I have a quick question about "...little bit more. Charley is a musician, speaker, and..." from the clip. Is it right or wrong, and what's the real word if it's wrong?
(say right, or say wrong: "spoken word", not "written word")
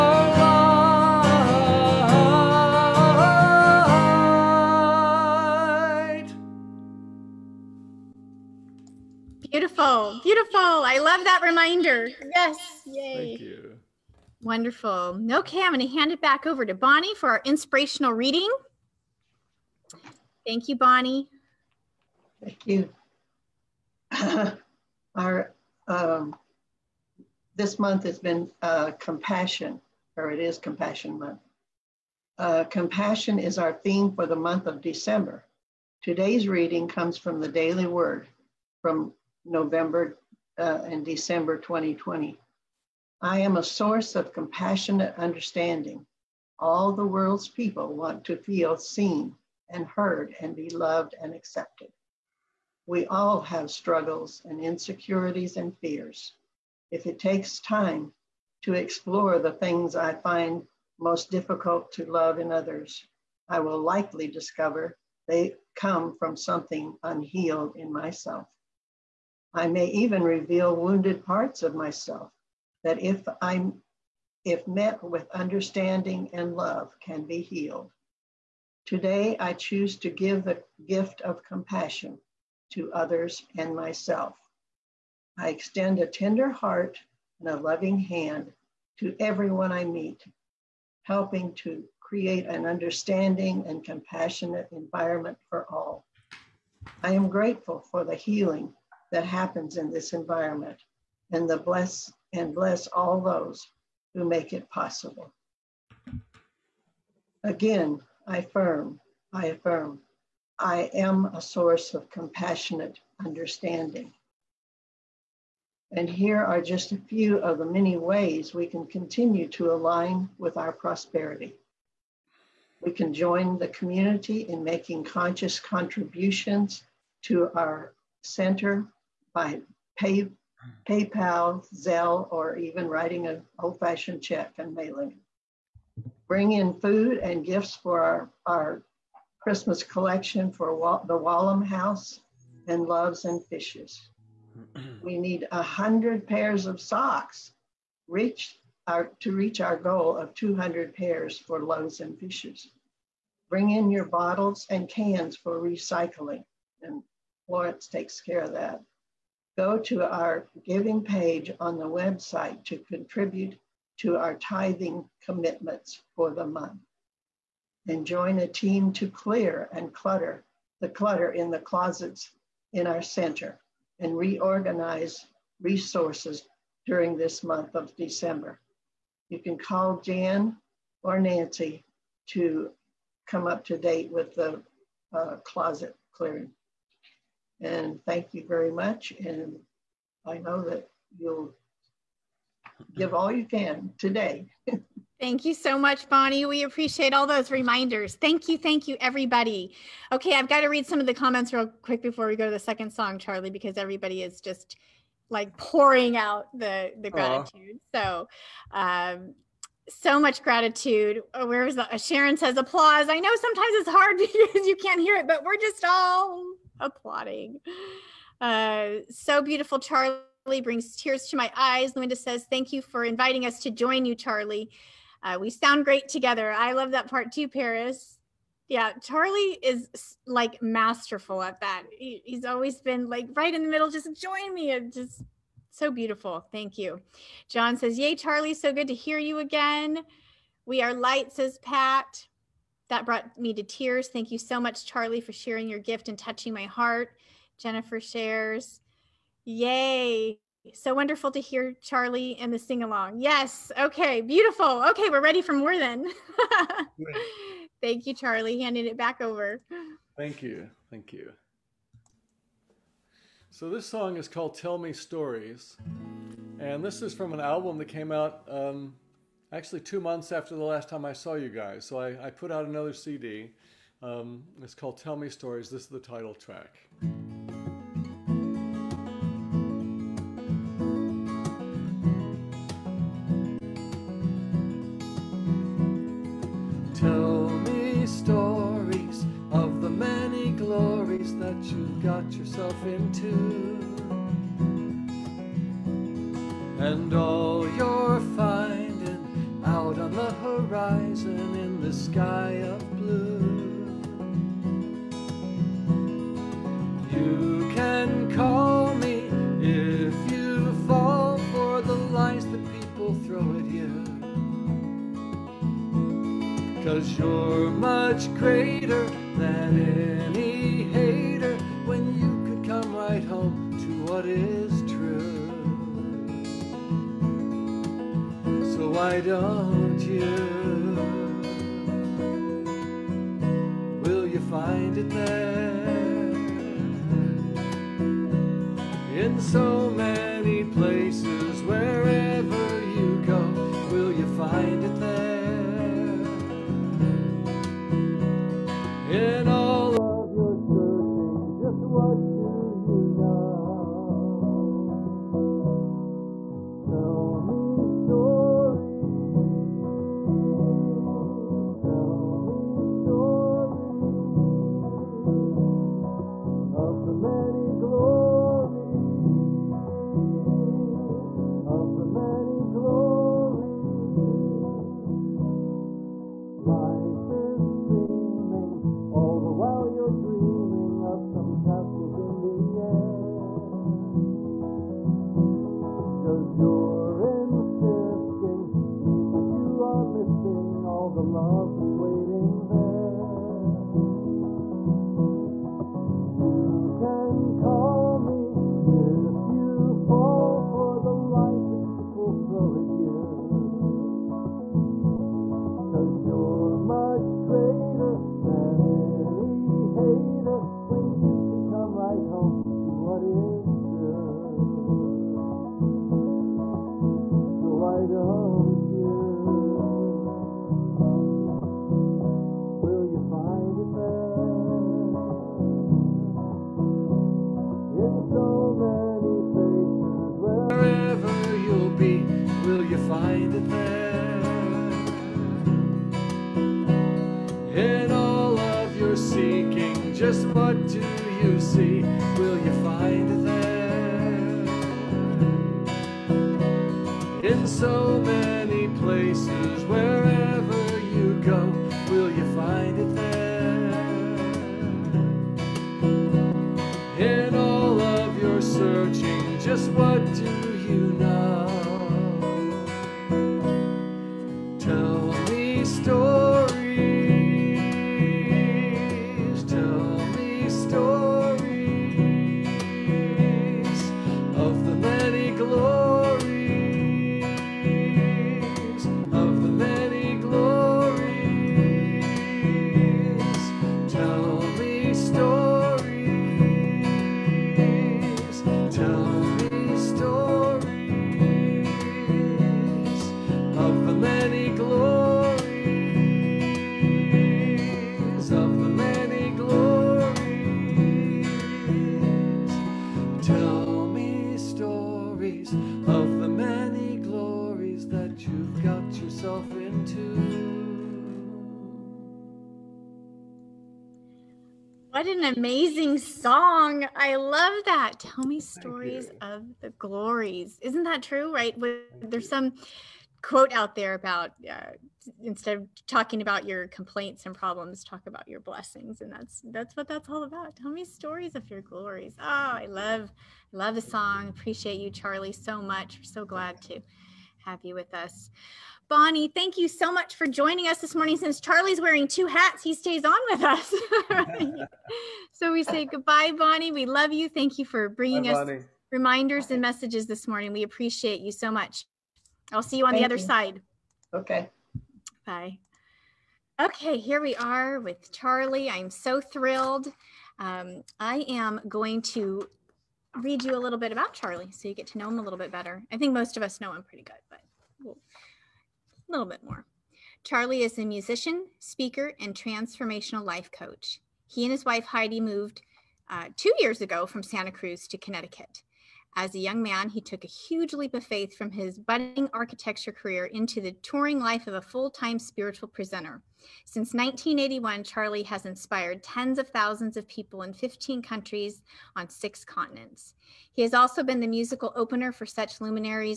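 right.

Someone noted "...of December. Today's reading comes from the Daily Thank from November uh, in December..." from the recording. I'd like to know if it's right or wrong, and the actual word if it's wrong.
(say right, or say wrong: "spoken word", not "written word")
wrong: "Word", not "Thank".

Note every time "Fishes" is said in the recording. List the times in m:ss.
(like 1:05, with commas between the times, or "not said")
2:23, 2:32.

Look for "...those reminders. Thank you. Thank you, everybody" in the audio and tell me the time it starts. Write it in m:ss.
3:17.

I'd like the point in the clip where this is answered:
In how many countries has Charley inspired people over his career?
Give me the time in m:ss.
9:50.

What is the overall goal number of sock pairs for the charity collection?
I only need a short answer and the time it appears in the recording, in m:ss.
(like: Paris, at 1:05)
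200, at 2:30.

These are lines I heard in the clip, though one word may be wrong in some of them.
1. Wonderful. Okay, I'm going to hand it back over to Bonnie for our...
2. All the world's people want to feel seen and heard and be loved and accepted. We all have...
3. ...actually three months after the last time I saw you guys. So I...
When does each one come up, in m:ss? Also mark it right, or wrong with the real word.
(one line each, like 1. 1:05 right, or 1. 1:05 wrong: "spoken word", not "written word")
1. 0:14 right
2. 0:46 right
3. 4:29 wrong: "two", not "three".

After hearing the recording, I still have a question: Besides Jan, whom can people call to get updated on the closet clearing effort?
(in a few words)
Nancy.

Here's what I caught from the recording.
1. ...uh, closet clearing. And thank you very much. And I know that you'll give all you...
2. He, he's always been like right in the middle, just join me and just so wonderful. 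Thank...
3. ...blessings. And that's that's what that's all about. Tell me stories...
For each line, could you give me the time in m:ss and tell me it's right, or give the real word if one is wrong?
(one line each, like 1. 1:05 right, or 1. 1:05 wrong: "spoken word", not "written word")
1. 3:05 right
2. 3:51 wrong: "beautiful", not "wonderful"
3. 8:48 right.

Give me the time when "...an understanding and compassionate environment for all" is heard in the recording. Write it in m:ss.
1:32.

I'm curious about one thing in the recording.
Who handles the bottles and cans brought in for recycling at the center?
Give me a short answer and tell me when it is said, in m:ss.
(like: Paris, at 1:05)
Florence, at 2:37.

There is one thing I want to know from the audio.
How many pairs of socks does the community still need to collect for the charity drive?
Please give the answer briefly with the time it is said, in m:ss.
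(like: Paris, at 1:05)
100, at 2:25.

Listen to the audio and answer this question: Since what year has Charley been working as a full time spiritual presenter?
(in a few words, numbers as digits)
1981.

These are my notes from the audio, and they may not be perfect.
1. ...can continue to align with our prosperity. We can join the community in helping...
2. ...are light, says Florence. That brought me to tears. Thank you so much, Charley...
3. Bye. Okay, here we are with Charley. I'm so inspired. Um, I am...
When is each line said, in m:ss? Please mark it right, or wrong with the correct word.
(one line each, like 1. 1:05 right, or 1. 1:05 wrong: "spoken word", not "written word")
1. 1:58 wrong: "making", not "helping"
2. 4:00 wrong: "Pat", not "Florence"
3. 9:15 wrong: "thrilled", not "inspired".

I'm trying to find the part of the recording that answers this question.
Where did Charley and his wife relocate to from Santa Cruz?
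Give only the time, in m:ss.
9:38.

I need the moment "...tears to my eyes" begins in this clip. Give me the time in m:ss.
3:40.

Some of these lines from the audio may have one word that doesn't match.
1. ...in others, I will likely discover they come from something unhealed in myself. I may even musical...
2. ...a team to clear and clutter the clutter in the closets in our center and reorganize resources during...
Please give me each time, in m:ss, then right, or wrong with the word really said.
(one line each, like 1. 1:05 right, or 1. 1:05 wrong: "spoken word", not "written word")
1. 1:02 wrong: "reveal", not "musical"
2. 2:48 right.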